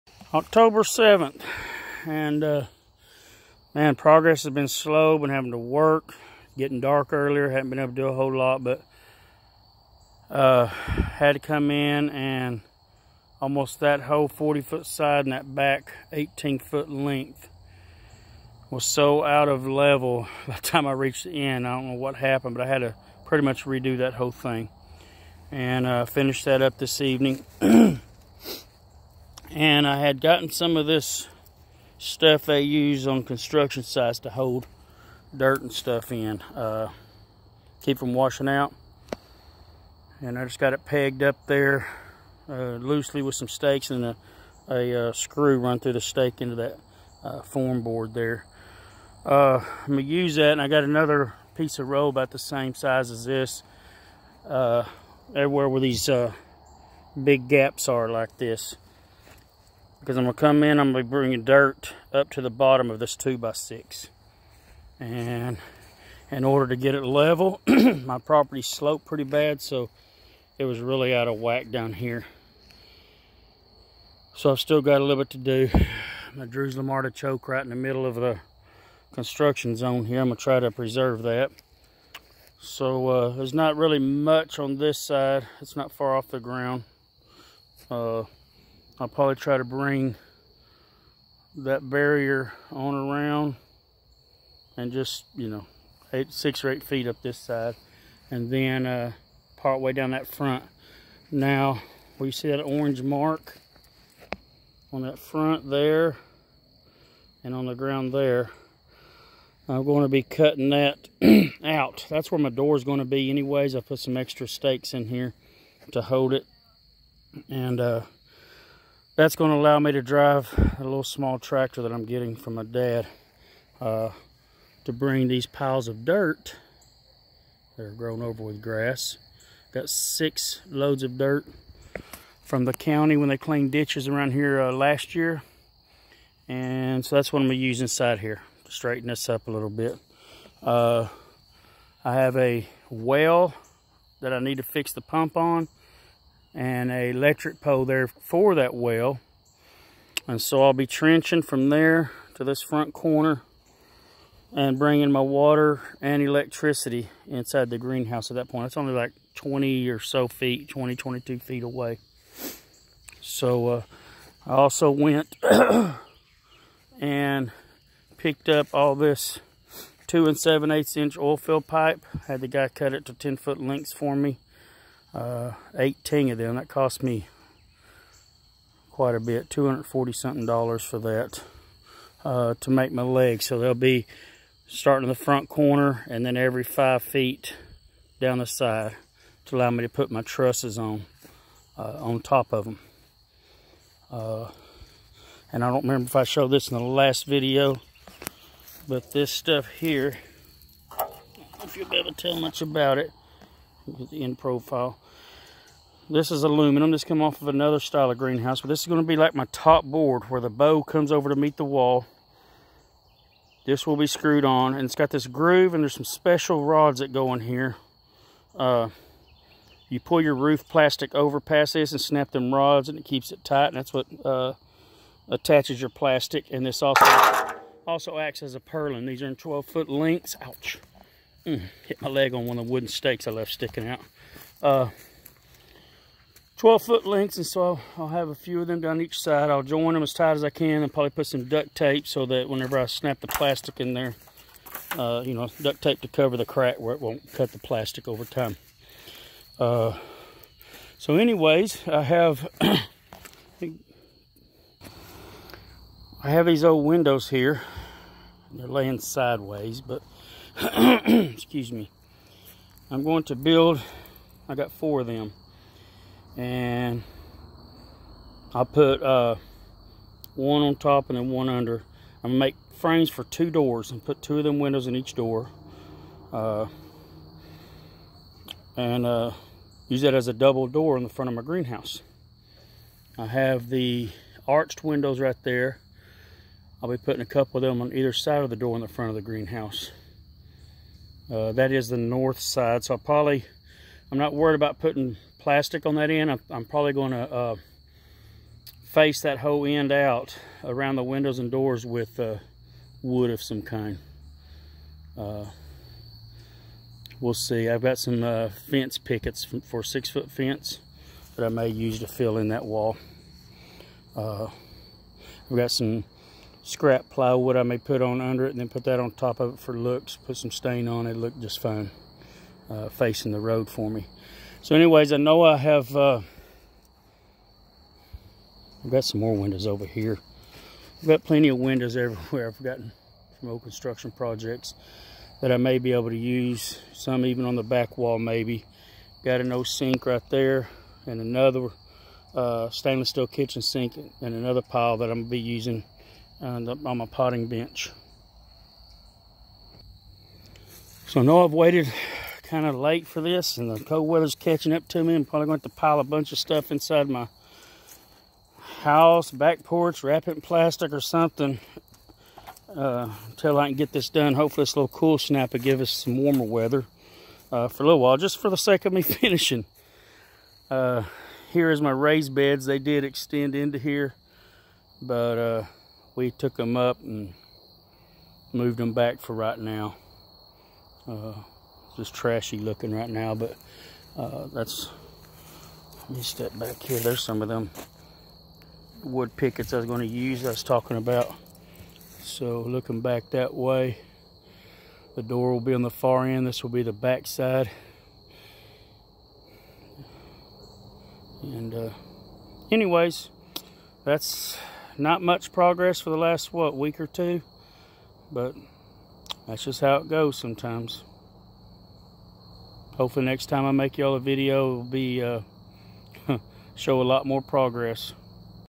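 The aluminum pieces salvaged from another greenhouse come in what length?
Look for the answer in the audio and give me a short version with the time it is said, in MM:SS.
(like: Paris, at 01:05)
12 feet, at 03:49.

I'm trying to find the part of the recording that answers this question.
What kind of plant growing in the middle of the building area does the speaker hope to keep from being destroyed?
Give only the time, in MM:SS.
01:16.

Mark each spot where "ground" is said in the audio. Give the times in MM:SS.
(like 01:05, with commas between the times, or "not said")
01:26, 01:47.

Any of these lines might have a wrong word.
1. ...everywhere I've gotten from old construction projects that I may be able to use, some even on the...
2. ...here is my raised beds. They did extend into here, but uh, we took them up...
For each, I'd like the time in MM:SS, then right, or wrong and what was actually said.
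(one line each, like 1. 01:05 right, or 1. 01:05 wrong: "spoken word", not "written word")
1. 05:31 right
2. 06:11 right.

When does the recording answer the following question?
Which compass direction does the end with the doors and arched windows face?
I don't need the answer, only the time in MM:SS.
04:51.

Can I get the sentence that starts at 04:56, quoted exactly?
I'm, I'm probably going to uh, face that whole end out around the windows and doors with uh, wood of some kind.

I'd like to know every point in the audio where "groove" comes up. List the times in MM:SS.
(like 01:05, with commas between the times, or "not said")
03:35.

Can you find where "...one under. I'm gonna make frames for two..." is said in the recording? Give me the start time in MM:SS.
04:31.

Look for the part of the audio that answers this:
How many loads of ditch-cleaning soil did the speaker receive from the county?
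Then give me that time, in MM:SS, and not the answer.
02:09.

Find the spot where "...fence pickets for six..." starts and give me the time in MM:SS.
05:08.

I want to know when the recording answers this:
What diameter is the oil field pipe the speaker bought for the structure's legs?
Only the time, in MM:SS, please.
02:50.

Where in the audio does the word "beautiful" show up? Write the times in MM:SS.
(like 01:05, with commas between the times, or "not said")
not said.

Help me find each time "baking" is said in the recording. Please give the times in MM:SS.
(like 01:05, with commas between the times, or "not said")
not said.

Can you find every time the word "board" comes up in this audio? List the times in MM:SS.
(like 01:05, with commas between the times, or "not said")
00:47, 03:29.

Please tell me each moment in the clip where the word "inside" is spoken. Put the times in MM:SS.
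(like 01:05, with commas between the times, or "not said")
02:17, 02:37, 05:56.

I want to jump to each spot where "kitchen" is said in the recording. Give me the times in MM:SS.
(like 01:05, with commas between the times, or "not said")
05:43.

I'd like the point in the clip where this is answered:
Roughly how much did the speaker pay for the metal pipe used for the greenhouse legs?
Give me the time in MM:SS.
02:59.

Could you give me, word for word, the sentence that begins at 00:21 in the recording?
I don't know what happened, but I had to pretty much redo that whole thing and uh, finish that up this evening.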